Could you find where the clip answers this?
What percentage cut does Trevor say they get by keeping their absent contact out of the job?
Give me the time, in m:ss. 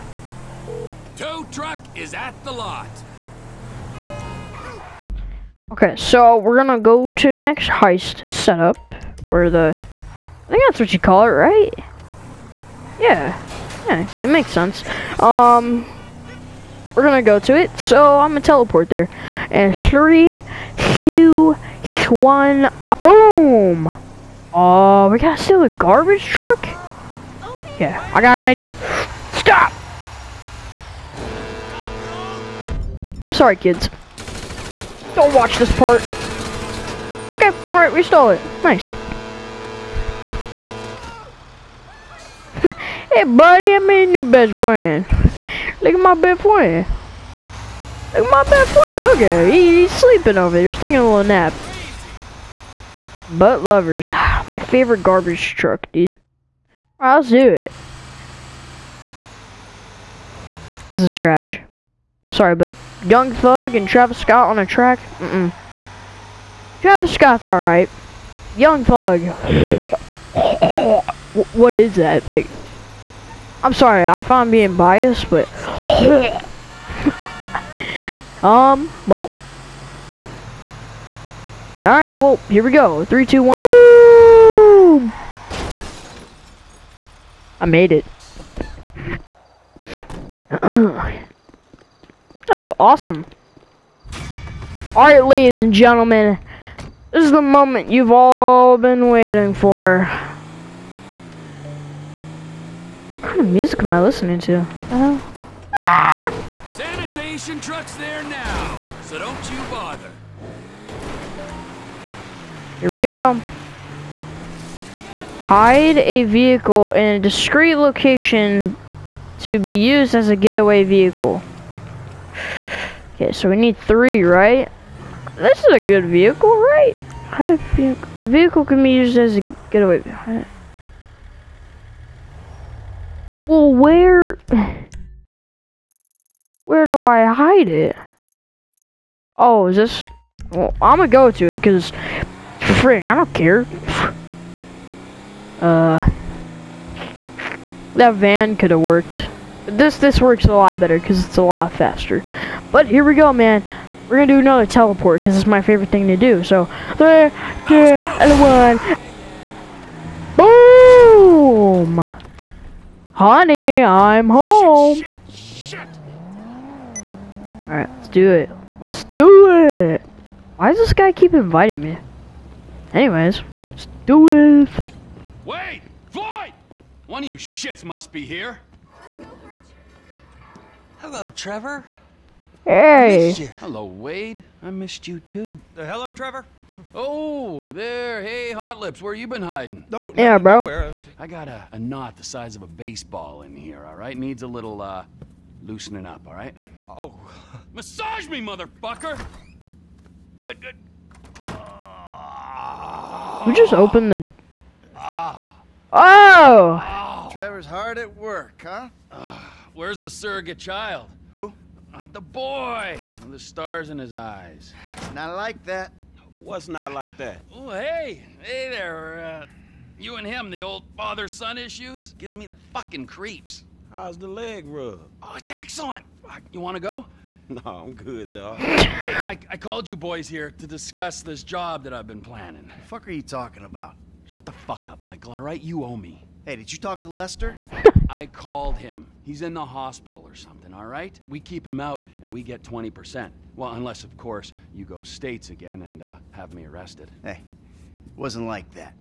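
4:02.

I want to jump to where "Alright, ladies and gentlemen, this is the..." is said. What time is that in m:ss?
1:34.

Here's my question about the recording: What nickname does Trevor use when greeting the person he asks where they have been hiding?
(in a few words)
Hot Lips.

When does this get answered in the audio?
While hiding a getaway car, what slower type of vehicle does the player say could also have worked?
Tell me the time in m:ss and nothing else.
2:28.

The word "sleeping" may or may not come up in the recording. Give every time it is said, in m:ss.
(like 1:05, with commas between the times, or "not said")
0:49.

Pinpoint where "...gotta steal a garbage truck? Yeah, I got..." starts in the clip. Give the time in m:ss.
0:25.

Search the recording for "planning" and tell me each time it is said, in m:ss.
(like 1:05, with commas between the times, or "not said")
3:52.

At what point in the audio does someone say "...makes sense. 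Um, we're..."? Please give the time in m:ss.
0:14.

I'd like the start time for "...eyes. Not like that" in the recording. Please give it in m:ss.
3:34.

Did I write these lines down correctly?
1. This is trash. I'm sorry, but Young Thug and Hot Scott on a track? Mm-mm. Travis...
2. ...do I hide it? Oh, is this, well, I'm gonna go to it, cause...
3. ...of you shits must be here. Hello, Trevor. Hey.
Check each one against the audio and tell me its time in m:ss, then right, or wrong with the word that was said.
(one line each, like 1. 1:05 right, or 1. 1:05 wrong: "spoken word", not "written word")
1. 1:00 wrong: "Travis", not "Hot"
2. 2:16 right
3. 2:57 right.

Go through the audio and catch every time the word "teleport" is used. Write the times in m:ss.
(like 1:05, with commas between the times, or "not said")
0:18, 2:34.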